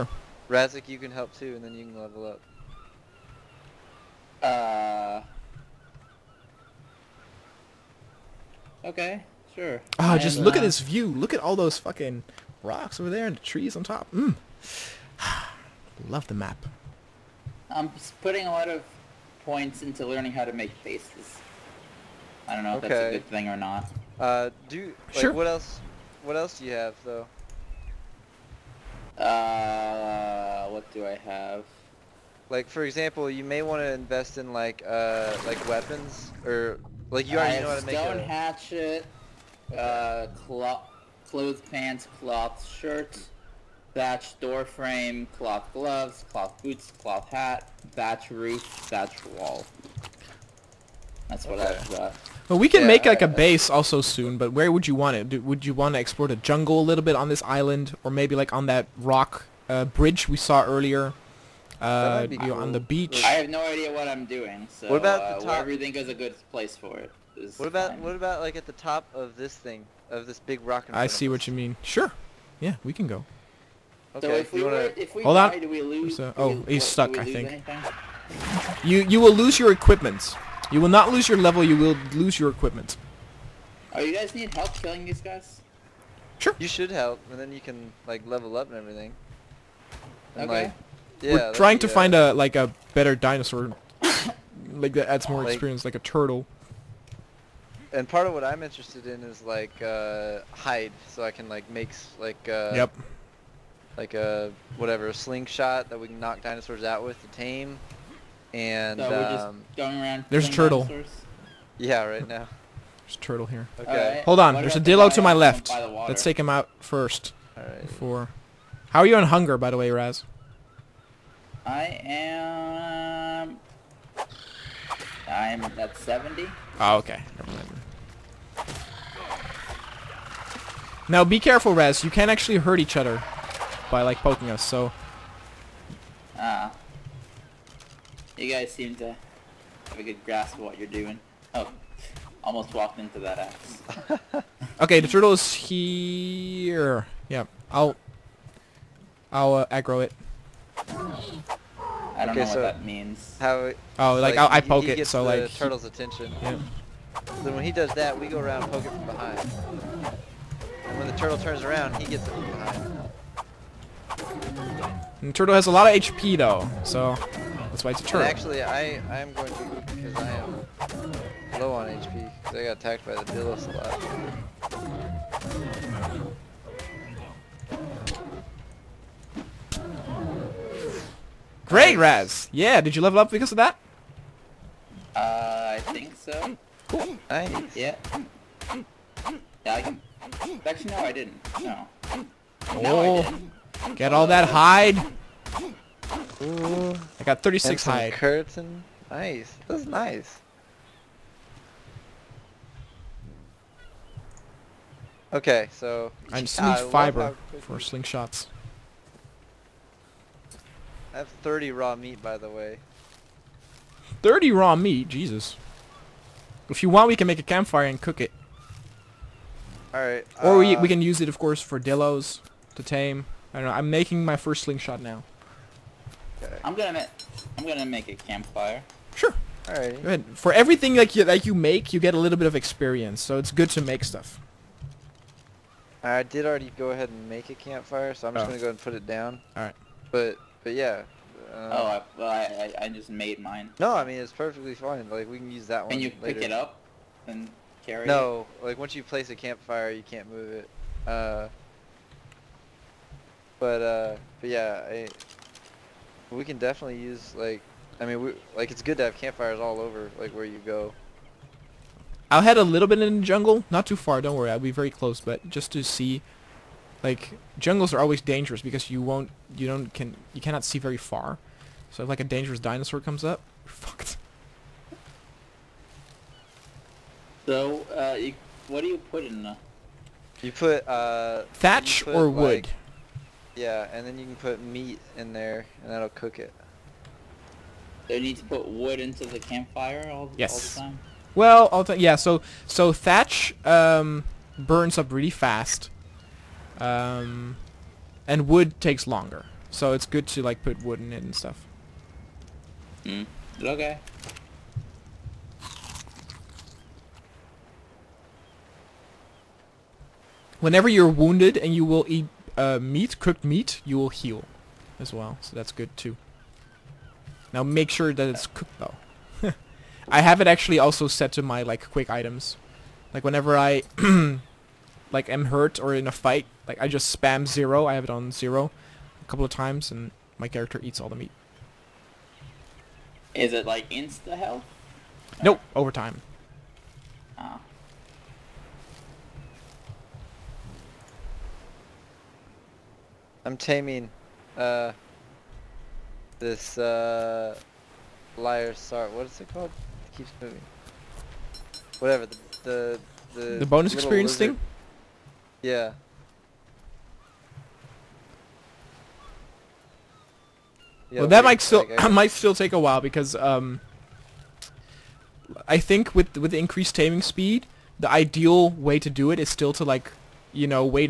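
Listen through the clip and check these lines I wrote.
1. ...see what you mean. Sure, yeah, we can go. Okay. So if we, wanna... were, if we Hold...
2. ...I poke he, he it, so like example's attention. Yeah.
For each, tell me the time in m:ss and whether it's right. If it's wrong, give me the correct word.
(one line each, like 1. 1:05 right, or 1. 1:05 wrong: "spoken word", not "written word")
1. 1:11 right
2. 2:34 wrong: "turtle", not "example".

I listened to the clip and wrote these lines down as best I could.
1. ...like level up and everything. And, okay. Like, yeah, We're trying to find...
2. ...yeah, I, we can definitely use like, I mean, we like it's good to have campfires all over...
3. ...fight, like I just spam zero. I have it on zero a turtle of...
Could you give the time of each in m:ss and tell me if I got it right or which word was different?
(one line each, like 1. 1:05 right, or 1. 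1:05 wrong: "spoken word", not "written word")
1. 1:28 right
2. 4:14 right
3. 5:26 wrong: "couple", not "turtle".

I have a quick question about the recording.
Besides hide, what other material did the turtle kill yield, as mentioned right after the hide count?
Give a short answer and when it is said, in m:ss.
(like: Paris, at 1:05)
keratin, at 3:18.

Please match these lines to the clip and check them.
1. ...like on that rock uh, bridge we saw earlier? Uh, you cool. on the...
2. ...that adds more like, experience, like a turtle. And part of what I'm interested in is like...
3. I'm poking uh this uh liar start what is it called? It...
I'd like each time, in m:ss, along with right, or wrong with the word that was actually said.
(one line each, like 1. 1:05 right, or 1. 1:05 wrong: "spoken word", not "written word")
1. 0:58 right
2. 1:34 right
3. 5:43 wrong: "taming", not "poking".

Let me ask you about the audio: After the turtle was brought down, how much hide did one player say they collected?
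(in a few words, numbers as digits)
36.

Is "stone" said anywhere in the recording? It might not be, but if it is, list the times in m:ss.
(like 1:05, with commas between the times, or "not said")
0:37.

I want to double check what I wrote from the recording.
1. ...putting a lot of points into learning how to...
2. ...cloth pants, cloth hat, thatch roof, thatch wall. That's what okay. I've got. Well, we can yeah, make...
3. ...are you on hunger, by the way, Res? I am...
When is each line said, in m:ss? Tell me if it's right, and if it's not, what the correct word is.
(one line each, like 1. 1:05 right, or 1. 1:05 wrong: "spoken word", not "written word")
1. 0:18 right
2. 0:46 wrong: "boots", not "pants"
3. 1:58 wrong: "Raz", not "Res".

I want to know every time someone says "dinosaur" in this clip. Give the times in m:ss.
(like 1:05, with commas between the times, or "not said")
1:33, 1:46, 1:50, 4:32.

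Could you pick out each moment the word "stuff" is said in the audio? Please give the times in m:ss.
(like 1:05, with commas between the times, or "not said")
3:54, 5:01.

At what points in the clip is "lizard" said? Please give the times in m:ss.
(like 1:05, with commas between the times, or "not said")
5:54.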